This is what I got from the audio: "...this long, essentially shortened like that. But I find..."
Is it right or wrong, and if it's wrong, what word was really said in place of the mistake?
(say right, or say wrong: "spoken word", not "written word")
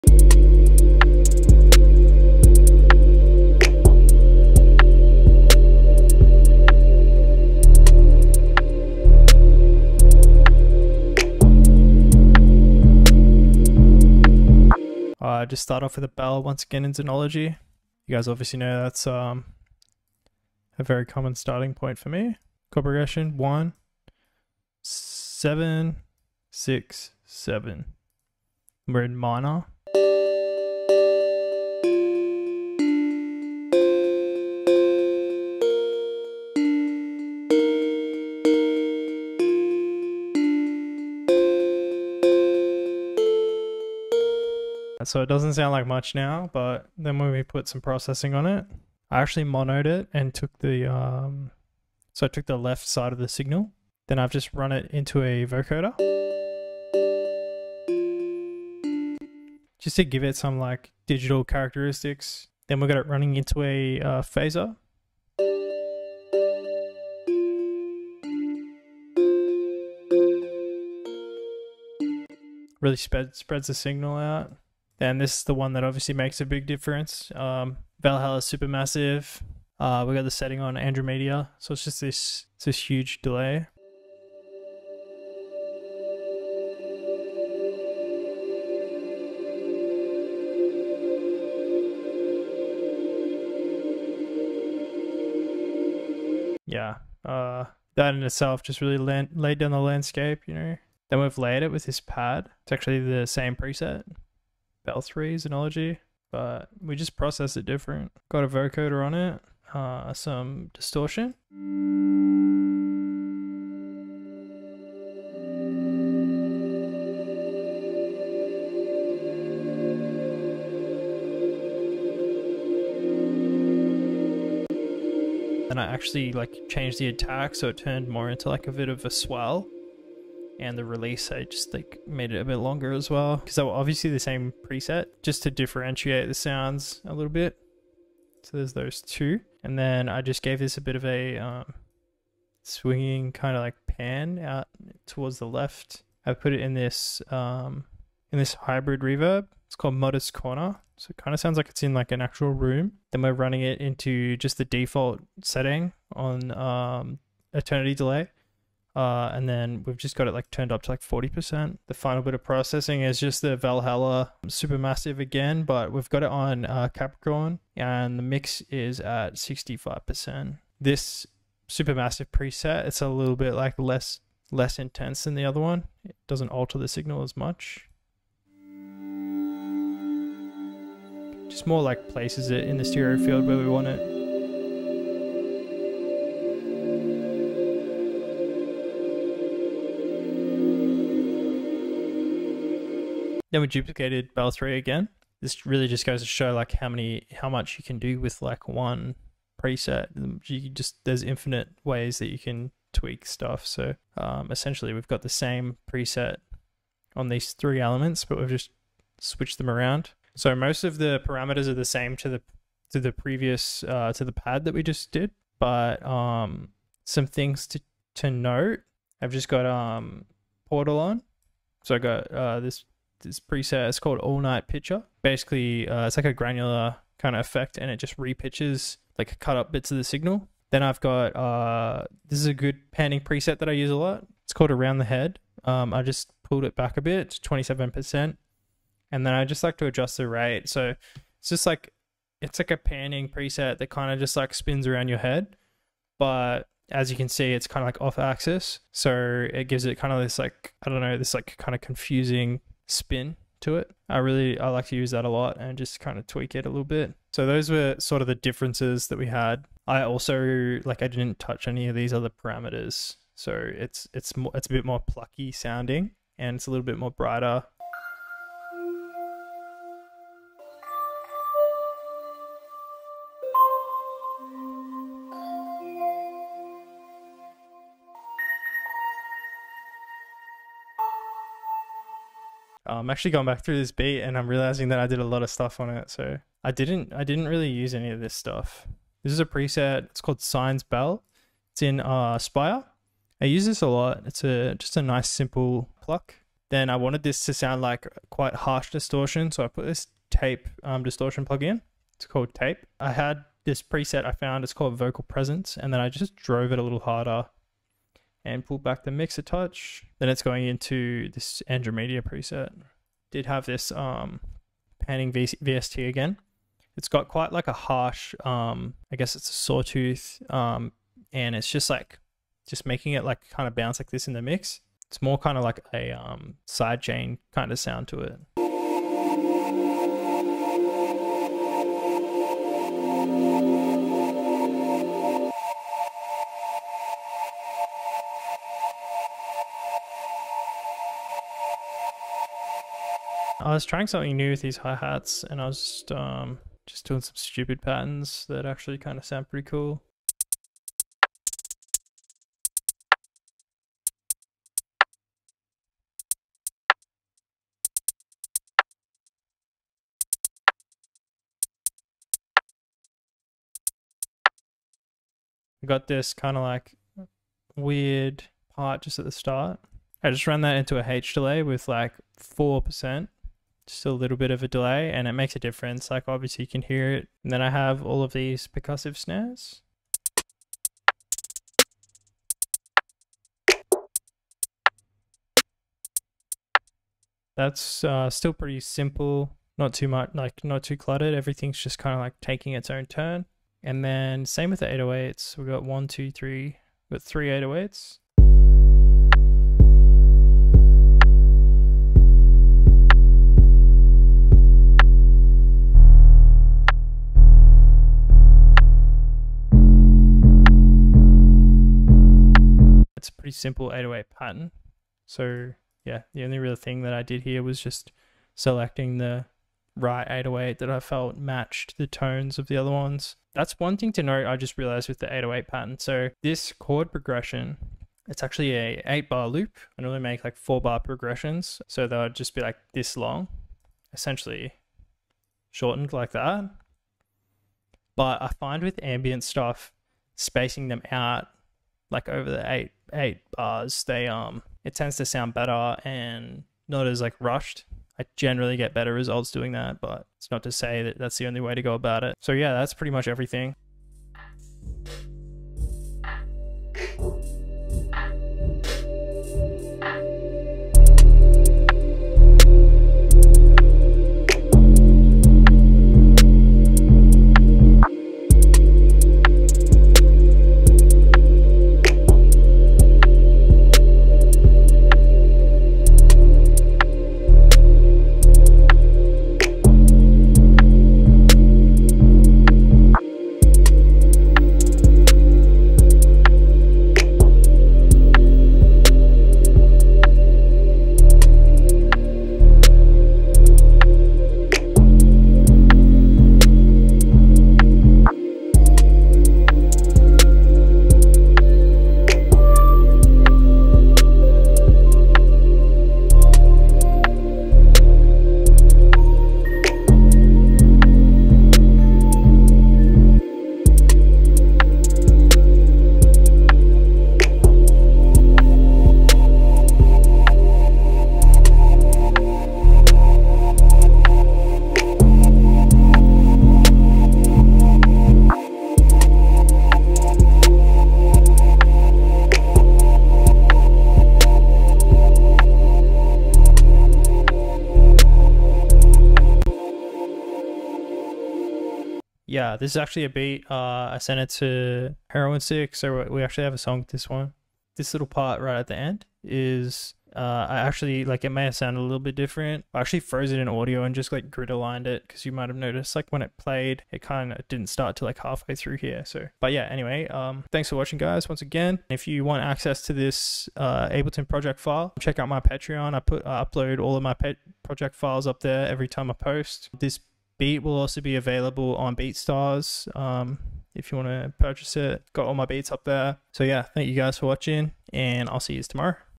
right.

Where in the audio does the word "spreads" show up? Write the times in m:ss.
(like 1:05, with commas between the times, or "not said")
1:12.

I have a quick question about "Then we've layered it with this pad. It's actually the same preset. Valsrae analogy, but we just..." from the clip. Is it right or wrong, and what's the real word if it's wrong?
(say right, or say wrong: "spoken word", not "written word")
right.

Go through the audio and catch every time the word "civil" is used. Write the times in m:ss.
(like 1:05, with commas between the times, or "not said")
not said.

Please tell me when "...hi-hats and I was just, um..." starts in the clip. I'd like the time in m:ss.
5:44.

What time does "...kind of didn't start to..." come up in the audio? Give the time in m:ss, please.
9:17.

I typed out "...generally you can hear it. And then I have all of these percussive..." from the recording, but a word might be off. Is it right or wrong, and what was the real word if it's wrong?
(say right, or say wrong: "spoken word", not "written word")
wrong: "obviously", not "generally".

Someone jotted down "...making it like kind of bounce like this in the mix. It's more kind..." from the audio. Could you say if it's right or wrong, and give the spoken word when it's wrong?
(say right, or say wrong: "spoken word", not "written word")
right.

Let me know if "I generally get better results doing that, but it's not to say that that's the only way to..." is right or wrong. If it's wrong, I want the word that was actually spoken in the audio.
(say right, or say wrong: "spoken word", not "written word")
right.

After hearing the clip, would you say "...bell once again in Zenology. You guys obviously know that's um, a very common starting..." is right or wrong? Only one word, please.
right.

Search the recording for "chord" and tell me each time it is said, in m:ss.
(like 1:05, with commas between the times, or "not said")
0:22, 7:06.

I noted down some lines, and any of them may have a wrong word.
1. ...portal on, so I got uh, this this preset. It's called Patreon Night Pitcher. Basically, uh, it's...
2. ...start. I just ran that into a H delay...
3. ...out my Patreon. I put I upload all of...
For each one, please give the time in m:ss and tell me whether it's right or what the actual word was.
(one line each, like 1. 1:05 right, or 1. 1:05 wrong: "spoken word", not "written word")
1. 3:40 wrong: "All", not "Patreon"
2. 6:09 right
3. 9:25 right.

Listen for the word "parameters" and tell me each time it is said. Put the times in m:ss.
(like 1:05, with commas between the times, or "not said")
3:31, 4:22.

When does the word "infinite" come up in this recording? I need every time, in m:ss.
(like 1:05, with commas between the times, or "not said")
3:21.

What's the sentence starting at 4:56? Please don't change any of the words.
Then I wanted this to sound like quite harsh distortion, so I put this tape um, distortion plug in.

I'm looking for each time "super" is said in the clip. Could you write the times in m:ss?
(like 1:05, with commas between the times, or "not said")
1:18, 2:44, 2:51.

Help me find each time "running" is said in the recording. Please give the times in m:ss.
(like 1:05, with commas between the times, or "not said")
1:03, 2:33.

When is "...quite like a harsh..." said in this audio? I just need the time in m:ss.
5:17.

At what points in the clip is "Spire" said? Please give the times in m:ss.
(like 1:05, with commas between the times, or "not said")
4:52.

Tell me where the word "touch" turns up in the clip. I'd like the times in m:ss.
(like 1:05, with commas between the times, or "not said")
4:21, 5:09.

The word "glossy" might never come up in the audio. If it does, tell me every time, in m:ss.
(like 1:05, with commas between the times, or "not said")
not said.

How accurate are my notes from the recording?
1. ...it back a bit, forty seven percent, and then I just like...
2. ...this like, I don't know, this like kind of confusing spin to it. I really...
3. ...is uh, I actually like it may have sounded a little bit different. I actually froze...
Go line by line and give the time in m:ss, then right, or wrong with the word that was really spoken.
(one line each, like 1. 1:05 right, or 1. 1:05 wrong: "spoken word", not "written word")
1. 3:56 wrong: "twenty", not "forty"
2. 4:10 right
3. 9:09 right.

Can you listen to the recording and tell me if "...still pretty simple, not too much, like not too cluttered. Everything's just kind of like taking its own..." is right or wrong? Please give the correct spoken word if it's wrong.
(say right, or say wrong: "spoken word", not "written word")
right.